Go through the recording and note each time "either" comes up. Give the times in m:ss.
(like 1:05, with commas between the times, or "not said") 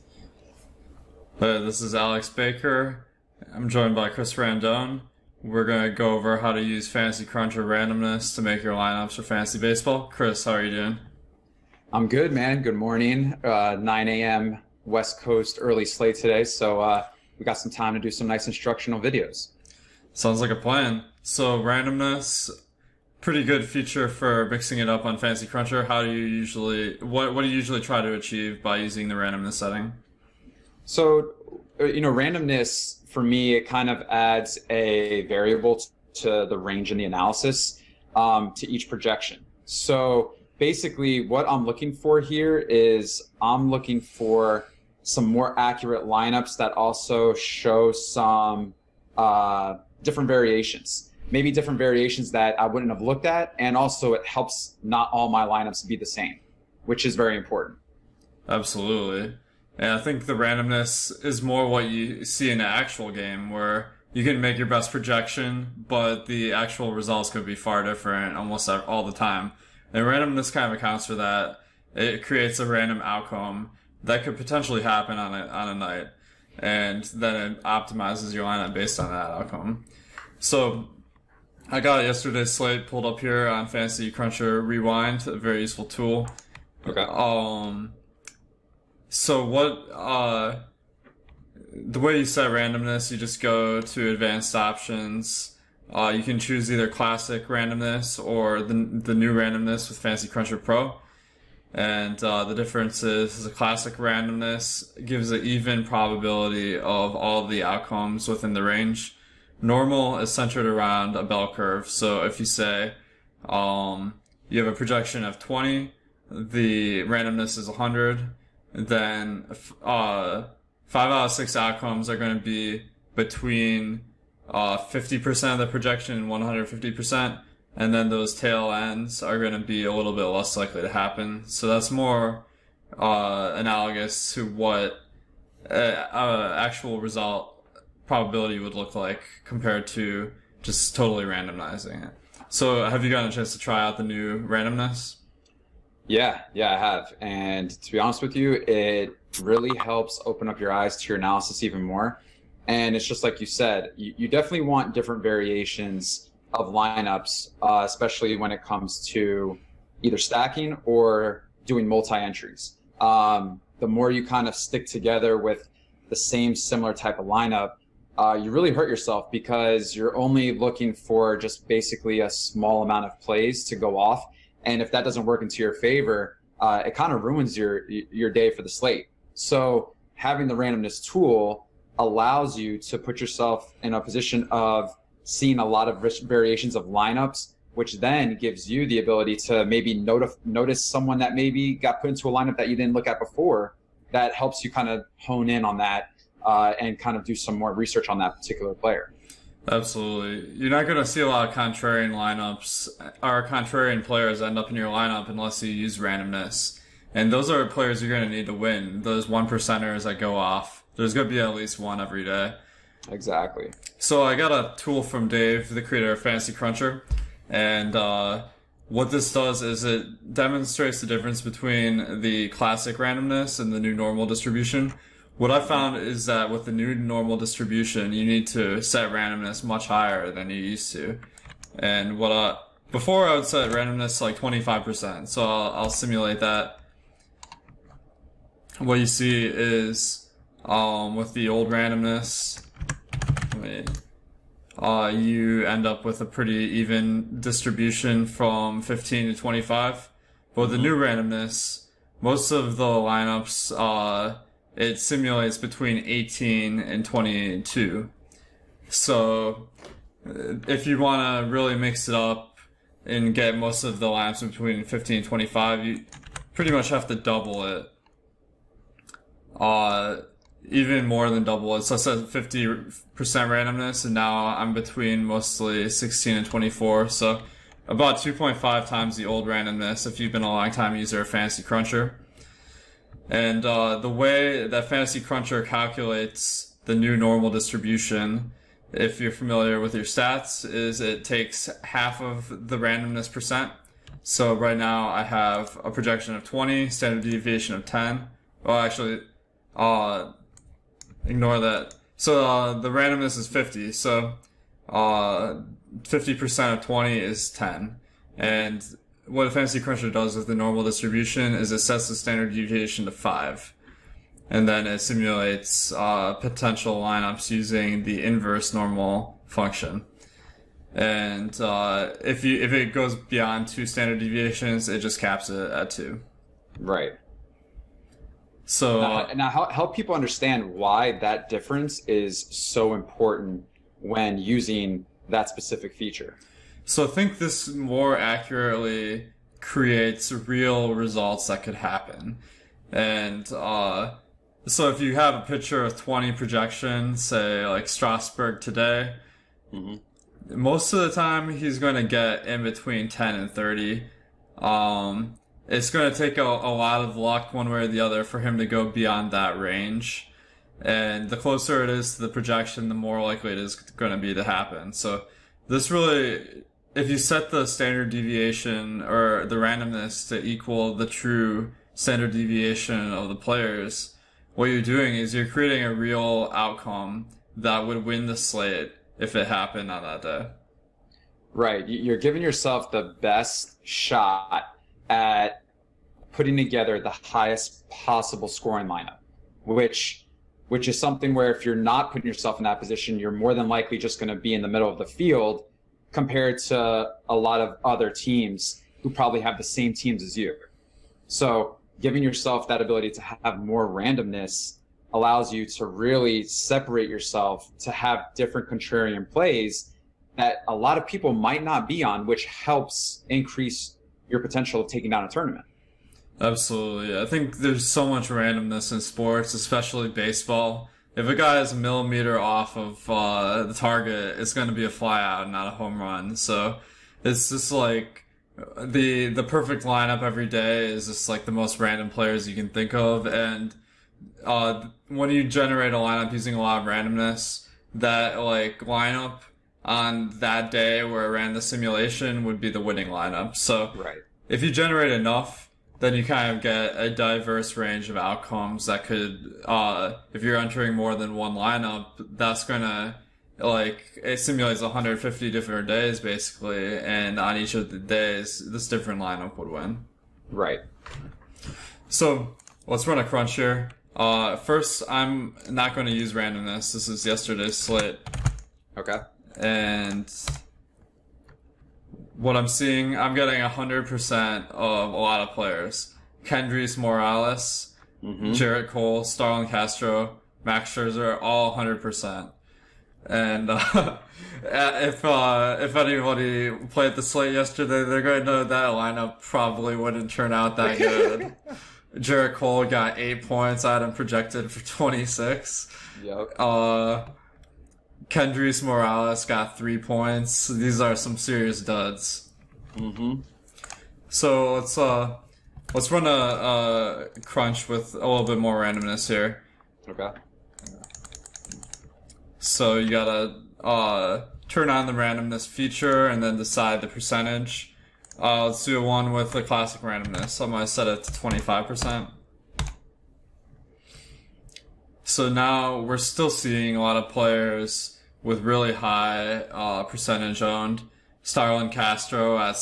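1:36, 2:40.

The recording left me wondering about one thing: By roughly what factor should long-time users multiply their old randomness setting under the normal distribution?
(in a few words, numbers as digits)
2.5.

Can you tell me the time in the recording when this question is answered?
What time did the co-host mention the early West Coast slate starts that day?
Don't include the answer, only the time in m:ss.
0:13.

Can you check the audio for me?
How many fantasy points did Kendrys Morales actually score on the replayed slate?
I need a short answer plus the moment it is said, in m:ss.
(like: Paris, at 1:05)
3, at 8:19.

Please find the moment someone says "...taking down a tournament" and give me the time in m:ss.
6:54.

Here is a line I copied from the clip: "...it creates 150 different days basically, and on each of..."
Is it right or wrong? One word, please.
wrong.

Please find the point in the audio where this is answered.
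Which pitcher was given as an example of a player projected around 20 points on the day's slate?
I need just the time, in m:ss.
5:47.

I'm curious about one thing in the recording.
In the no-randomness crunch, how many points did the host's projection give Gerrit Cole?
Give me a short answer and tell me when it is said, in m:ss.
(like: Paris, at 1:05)
26, at 8:14.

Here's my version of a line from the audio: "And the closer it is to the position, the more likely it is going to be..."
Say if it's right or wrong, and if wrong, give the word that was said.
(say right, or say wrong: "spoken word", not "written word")
wrong: "projection", not "position".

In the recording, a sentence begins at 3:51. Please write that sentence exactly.
And what I, before I would set randomness like 25%, so I'll, I'll simulate that.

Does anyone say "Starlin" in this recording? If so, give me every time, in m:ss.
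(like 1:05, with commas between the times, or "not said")
7:59, 8:51.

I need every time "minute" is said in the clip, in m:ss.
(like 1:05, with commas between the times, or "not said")
not said.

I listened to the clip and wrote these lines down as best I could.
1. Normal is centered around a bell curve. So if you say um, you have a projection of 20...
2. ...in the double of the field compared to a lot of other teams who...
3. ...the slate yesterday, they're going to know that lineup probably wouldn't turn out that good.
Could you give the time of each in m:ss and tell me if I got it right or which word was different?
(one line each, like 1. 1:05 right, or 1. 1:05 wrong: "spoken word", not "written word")
1. 1:49 right
2. 6:34 wrong: "middle", not "double"
3. 8:07 right.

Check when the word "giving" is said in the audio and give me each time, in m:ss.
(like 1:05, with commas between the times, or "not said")
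6:22, 6:41.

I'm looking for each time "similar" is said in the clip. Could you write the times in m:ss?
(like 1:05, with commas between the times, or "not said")
2:46.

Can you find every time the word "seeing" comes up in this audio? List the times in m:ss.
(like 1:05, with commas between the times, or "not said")
3:05, 7:52, 8:46.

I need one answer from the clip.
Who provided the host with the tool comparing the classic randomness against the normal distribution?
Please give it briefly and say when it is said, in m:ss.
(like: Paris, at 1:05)
Dave, at 3:35.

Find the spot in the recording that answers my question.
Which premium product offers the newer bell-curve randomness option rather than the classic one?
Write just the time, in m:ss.
1:39.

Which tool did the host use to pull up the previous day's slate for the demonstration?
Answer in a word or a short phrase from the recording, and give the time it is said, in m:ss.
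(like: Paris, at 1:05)
Fantasy Cruncher Rewind, at 1:23.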